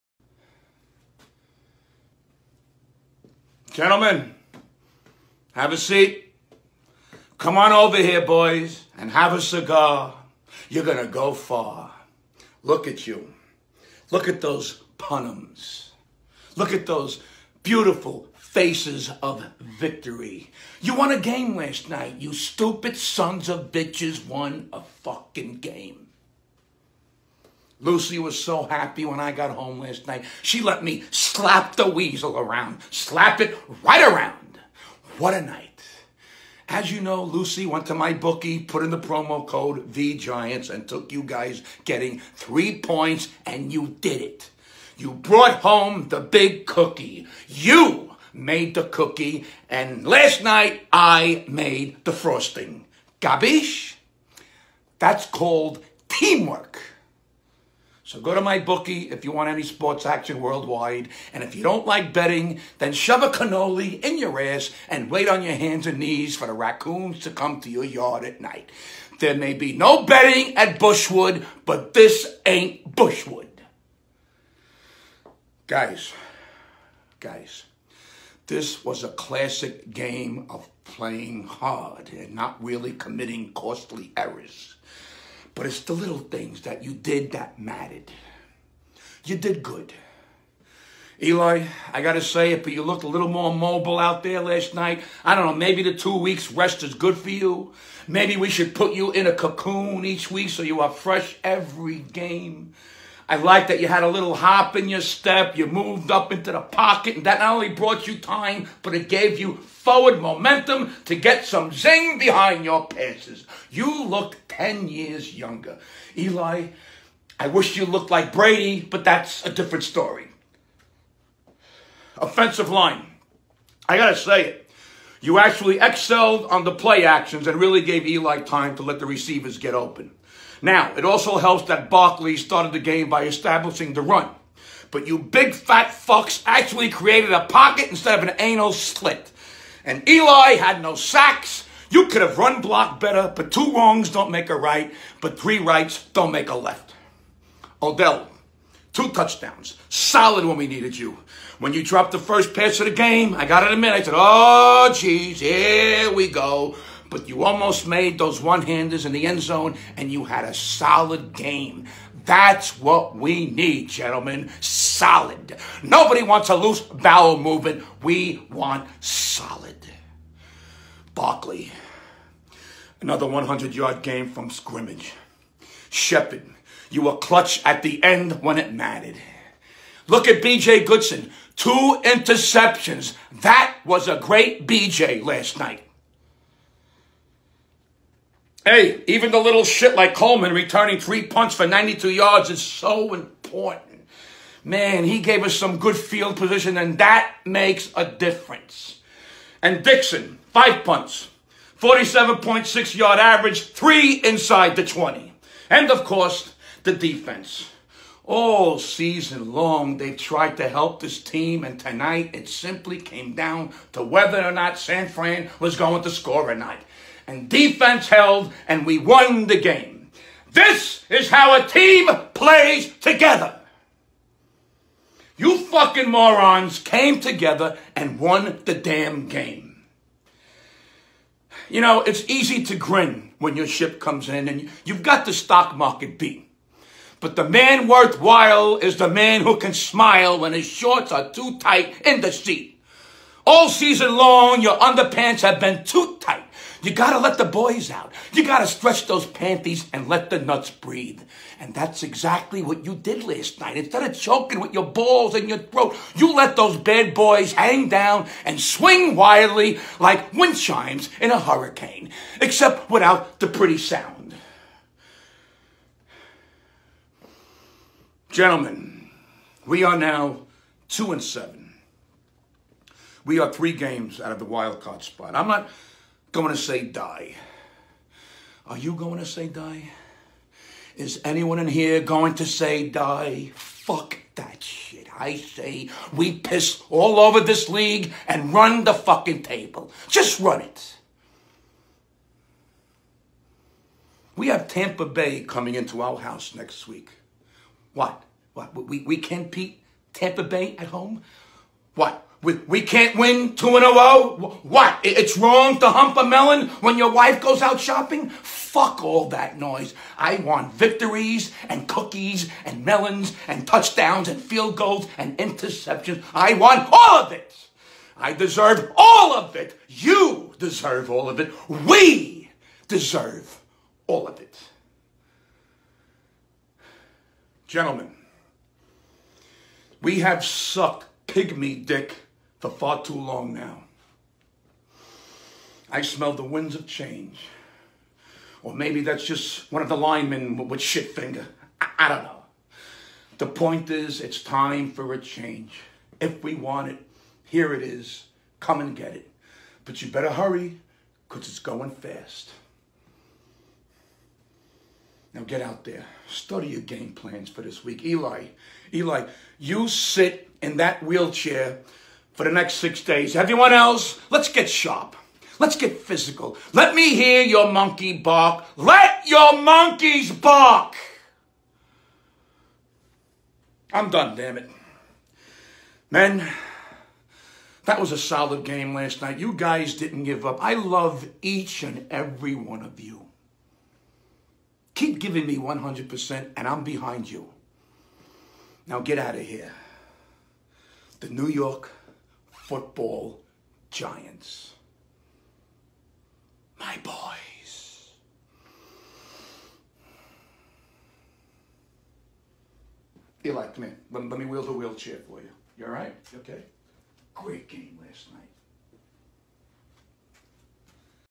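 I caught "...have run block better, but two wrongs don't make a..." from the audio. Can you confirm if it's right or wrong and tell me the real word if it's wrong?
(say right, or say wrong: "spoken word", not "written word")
right.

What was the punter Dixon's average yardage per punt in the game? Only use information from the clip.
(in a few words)
47.6.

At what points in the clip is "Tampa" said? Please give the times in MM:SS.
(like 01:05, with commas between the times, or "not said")
04:54, 05:00.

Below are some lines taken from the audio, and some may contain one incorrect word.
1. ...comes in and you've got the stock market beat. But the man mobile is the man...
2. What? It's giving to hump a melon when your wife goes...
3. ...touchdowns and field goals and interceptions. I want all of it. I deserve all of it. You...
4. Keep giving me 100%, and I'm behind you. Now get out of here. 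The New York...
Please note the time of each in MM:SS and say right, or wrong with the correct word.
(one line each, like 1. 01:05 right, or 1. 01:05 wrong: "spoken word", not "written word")
1. 03:53 wrong: "worthwhile", not "mobile"
2. 05:04 wrong: "wrong", not "giving"
3. 05:13 right
4. 06:24 right.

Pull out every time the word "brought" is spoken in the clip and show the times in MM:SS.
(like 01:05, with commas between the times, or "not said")
00:45, 01:47.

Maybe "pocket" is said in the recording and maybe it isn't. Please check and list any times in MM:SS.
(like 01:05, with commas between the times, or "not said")
01:46, 02:17.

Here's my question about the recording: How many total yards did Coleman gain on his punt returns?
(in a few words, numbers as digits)
92.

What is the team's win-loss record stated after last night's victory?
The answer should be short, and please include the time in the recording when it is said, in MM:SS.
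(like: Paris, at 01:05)
2 and 7, at 04:30.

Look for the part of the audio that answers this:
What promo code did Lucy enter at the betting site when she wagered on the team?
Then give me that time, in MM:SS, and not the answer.
00:39.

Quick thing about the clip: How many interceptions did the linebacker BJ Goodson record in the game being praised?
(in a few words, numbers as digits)
2.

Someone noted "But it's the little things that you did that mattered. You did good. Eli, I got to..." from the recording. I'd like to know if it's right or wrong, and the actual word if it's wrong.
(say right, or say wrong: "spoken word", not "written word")
right.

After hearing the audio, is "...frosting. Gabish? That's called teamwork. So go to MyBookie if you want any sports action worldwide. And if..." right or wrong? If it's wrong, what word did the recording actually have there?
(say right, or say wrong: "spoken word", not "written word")
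right.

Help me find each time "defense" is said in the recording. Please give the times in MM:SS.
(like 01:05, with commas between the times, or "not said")
03:26, 03:37.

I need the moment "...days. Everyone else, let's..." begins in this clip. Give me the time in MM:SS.
06:03.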